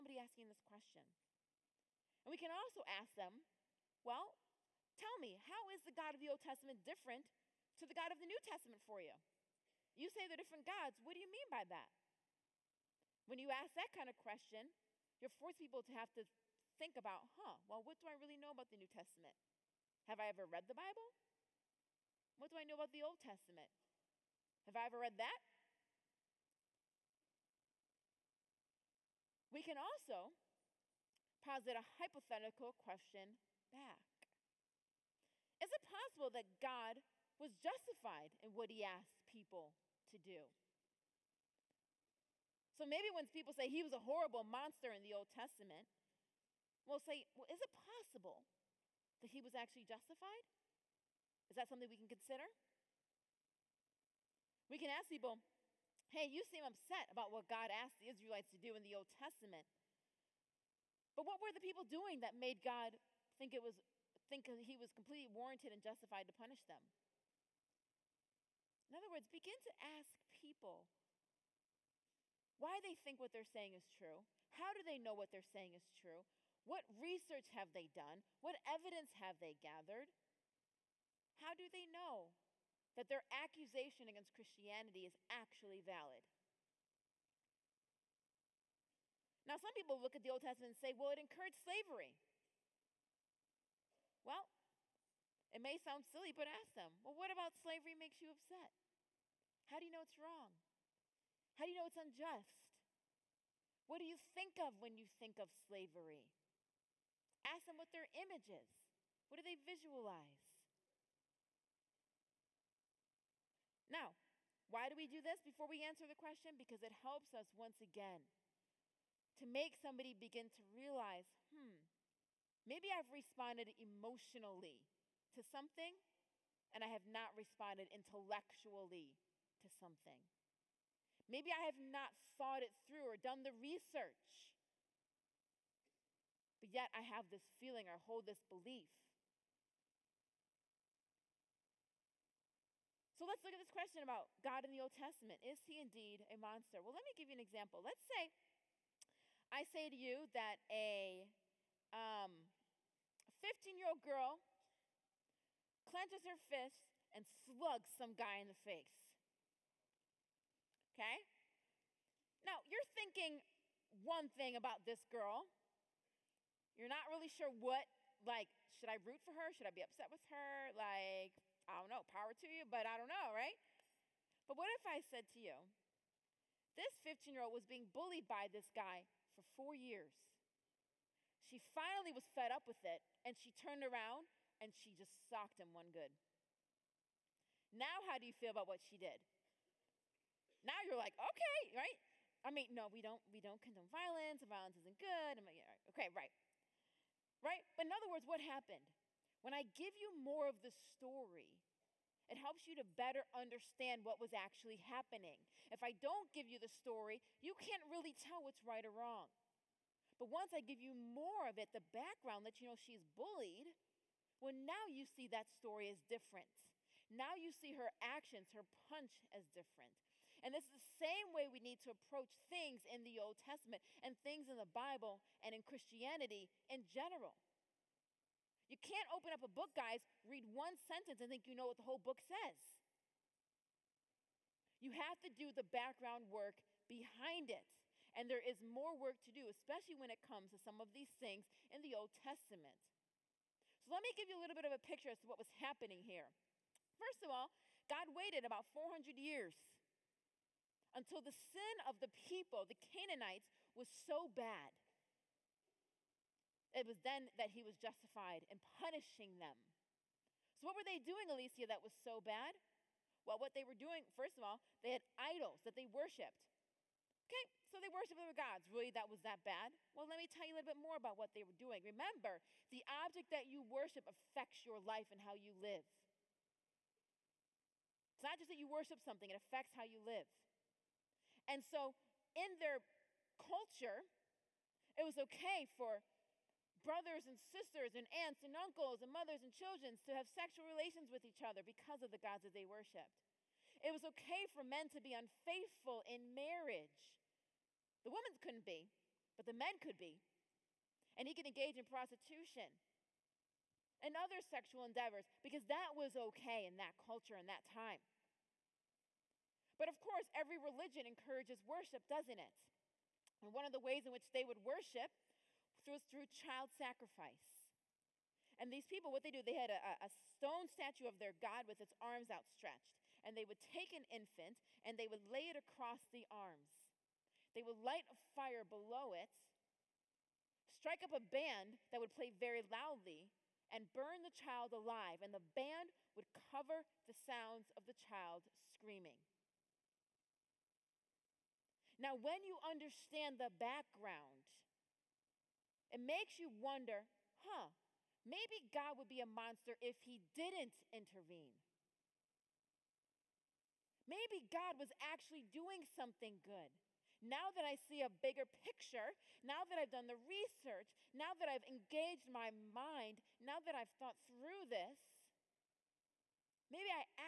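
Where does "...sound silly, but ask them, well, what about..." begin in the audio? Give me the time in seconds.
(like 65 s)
95 s.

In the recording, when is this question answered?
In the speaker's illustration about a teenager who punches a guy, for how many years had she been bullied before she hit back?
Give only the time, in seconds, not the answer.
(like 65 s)
179 s.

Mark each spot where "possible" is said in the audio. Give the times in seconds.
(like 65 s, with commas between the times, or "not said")
35 s, 47 s.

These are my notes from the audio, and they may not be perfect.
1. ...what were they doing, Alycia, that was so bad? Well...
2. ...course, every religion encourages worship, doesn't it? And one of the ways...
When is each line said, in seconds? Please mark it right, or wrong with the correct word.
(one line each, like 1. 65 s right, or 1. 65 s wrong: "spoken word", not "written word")
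1. 260 s right
2. 309 s right.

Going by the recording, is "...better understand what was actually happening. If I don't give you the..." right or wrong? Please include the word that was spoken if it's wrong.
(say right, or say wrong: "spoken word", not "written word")
right.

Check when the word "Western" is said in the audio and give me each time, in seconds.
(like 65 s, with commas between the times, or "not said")
not said.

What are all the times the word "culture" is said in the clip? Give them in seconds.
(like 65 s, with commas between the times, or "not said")
283 s, 306 s.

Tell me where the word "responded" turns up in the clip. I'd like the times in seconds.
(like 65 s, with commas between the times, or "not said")
123 s, 127 s.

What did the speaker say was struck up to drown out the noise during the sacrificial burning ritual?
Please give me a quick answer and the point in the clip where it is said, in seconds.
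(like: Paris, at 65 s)
A band, at 331 s.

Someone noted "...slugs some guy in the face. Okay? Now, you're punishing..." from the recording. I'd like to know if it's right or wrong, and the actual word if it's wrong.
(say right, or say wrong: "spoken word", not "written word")
wrong: "thinking", not "punishing".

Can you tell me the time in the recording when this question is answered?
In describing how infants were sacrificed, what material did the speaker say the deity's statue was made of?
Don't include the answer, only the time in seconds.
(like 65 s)
320 s.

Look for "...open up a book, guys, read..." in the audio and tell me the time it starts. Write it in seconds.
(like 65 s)
229 s.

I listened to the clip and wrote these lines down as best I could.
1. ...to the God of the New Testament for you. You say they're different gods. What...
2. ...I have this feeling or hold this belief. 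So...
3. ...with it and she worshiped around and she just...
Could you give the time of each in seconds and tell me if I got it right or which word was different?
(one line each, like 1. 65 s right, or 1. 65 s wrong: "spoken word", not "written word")
1. 7 s right
2. 136 s right
3. 182 s wrong: "turned", not "worshiped".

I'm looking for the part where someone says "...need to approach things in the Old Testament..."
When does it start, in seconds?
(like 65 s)
221 s.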